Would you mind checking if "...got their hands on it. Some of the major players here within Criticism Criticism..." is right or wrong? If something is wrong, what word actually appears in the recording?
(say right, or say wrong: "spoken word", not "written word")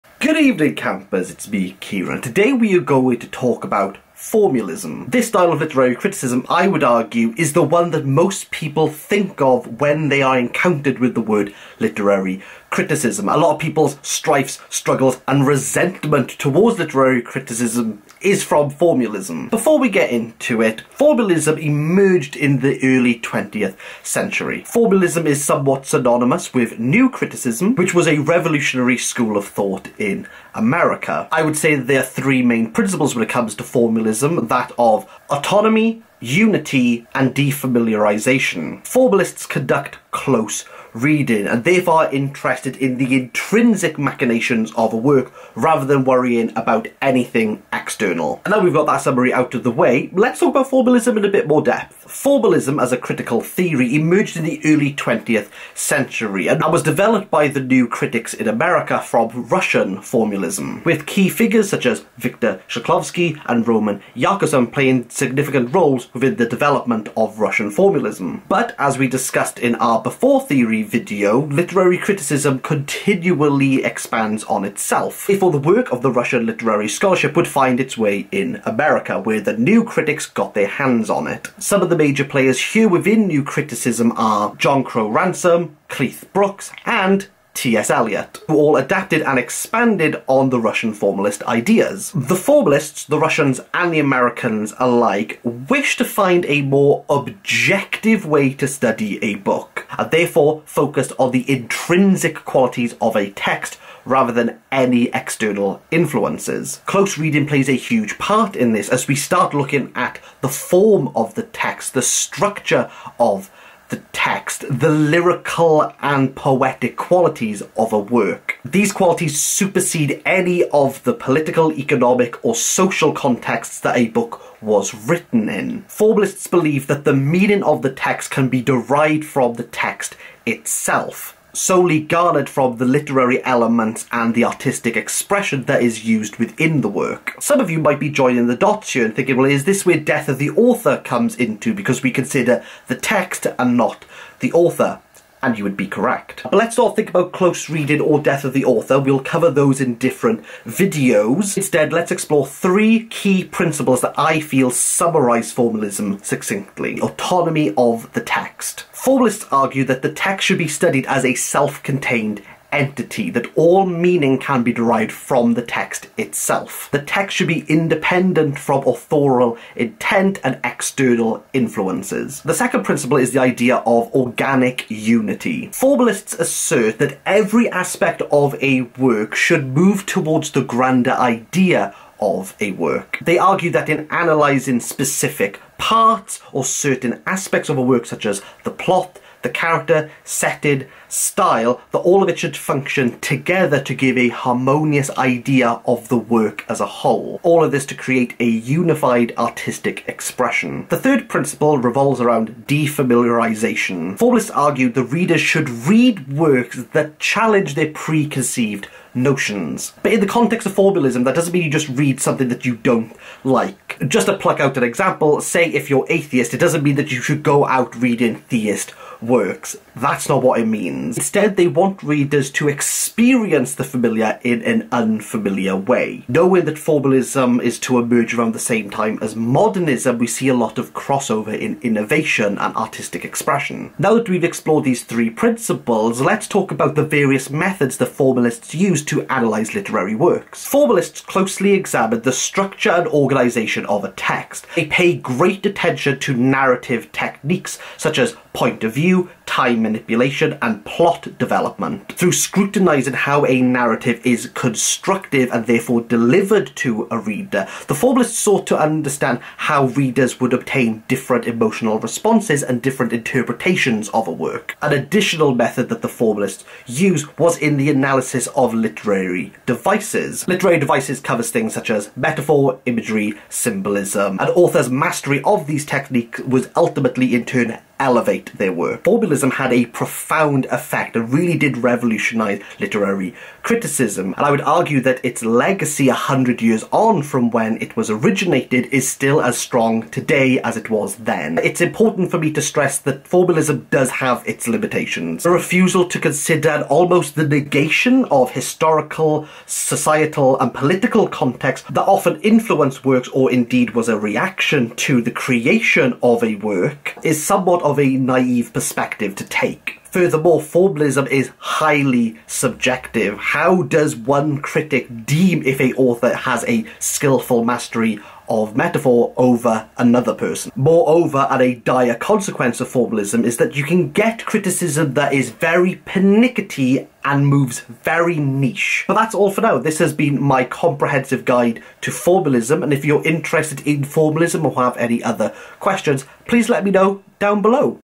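wrong: "New", not "Criticism".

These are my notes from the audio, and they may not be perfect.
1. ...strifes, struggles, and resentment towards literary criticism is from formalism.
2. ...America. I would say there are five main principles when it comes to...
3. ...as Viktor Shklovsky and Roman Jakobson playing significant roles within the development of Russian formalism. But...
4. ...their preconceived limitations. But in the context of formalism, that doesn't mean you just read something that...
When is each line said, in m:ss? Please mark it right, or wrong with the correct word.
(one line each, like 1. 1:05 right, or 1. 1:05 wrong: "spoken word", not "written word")
1. 0:14 right
2. 0:30 wrong: "three", not "five"
3. 1:01 right
4. 3:27 wrong: "notions", not "limitations".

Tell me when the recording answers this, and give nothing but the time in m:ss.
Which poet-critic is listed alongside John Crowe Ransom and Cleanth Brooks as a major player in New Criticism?
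1:27.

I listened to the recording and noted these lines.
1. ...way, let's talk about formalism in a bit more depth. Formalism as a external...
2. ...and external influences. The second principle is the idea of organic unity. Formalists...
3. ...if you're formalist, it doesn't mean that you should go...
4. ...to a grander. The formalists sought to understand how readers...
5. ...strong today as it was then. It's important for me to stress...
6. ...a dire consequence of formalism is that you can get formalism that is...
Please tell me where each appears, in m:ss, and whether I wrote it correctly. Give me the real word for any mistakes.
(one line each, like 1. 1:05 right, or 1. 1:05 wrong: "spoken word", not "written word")
1. 0:49 wrong: "critical", not "external"
2. 2:50 right
3. 3:35 wrong: "atheist", not "formalist"
4. 4:16 wrong: "reader", not "grander"
5. 4:49 right
6. 5:21 wrong: "criticism", not "formalism".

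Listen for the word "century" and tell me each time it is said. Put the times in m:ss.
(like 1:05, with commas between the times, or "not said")
0:24, 0:55.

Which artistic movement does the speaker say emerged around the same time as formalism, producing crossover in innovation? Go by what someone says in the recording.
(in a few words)
Modernism.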